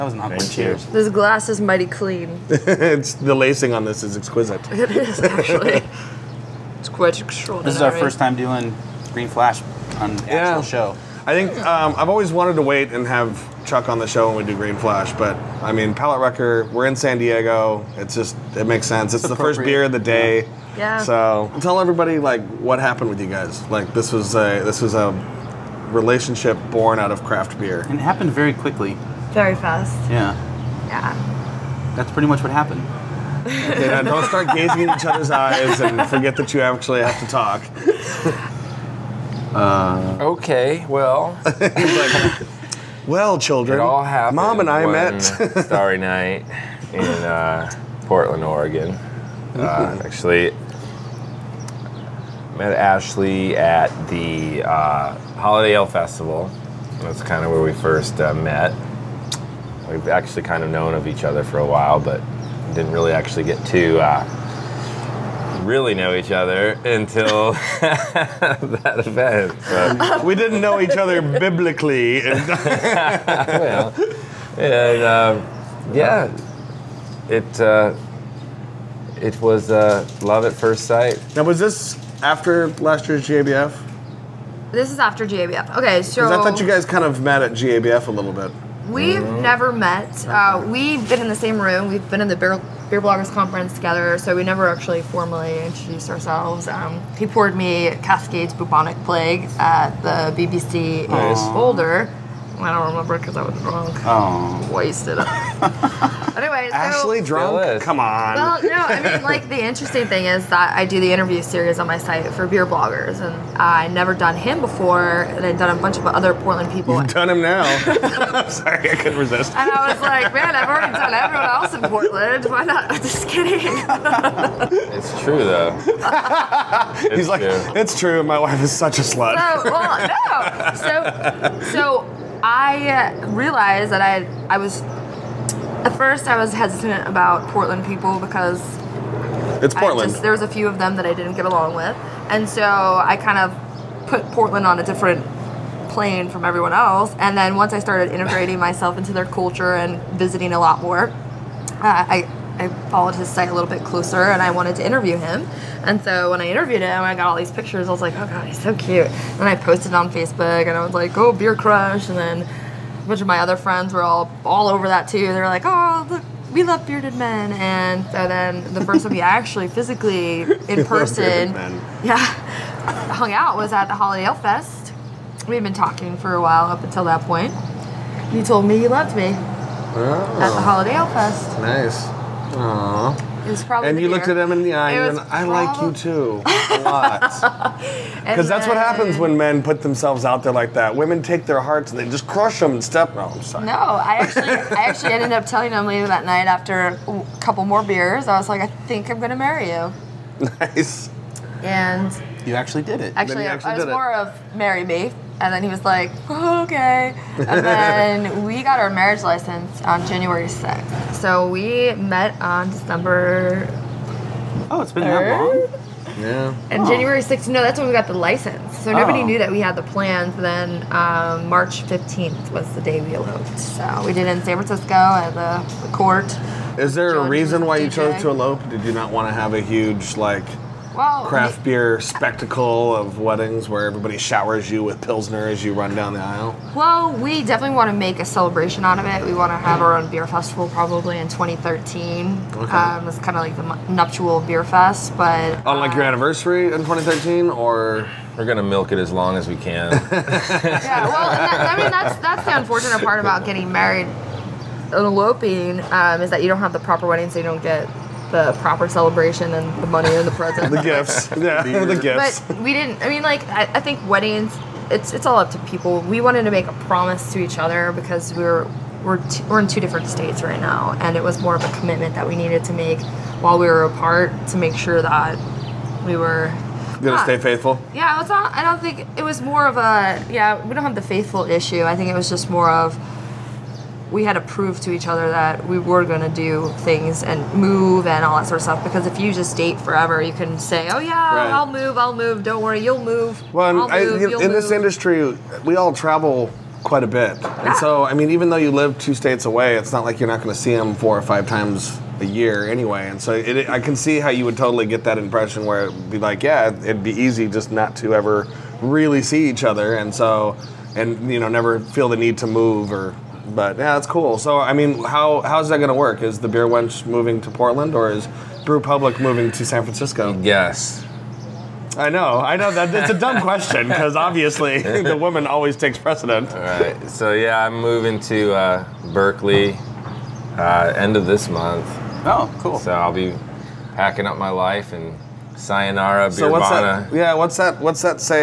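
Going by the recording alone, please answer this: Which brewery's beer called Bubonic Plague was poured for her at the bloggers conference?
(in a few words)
Cascade.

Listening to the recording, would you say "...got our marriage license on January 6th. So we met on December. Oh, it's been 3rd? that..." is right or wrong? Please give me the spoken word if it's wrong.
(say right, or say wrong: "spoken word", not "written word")
right.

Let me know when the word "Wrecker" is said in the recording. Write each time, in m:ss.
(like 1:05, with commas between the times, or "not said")
0:16.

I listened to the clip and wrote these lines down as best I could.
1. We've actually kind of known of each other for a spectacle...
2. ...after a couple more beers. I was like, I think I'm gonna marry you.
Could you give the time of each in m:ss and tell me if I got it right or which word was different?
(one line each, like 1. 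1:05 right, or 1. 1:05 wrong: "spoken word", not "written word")
1. 0:59 wrong: "while", not "spectacle"
2. 3:16 right.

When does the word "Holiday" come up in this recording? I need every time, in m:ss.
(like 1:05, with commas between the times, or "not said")
0:55, 2:53, 3:00.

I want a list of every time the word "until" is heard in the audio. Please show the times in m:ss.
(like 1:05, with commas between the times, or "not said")
1:06, 2:56.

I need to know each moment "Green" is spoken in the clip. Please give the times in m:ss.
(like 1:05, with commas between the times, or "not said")
0:09, 0:14.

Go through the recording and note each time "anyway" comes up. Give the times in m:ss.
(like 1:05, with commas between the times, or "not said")
1:45, 5:02.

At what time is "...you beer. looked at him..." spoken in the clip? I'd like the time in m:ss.
3:03.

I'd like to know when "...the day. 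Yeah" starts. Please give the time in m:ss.
0:19.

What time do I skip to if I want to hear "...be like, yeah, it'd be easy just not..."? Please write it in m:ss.
5:06.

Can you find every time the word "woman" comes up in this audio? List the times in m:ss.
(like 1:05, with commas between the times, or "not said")
5:25.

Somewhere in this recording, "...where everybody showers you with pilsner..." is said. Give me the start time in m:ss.
3:53.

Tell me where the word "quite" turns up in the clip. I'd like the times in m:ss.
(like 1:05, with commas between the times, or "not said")
0:06, 4:56.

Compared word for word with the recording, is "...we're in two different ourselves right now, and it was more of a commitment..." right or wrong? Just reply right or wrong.
wrong.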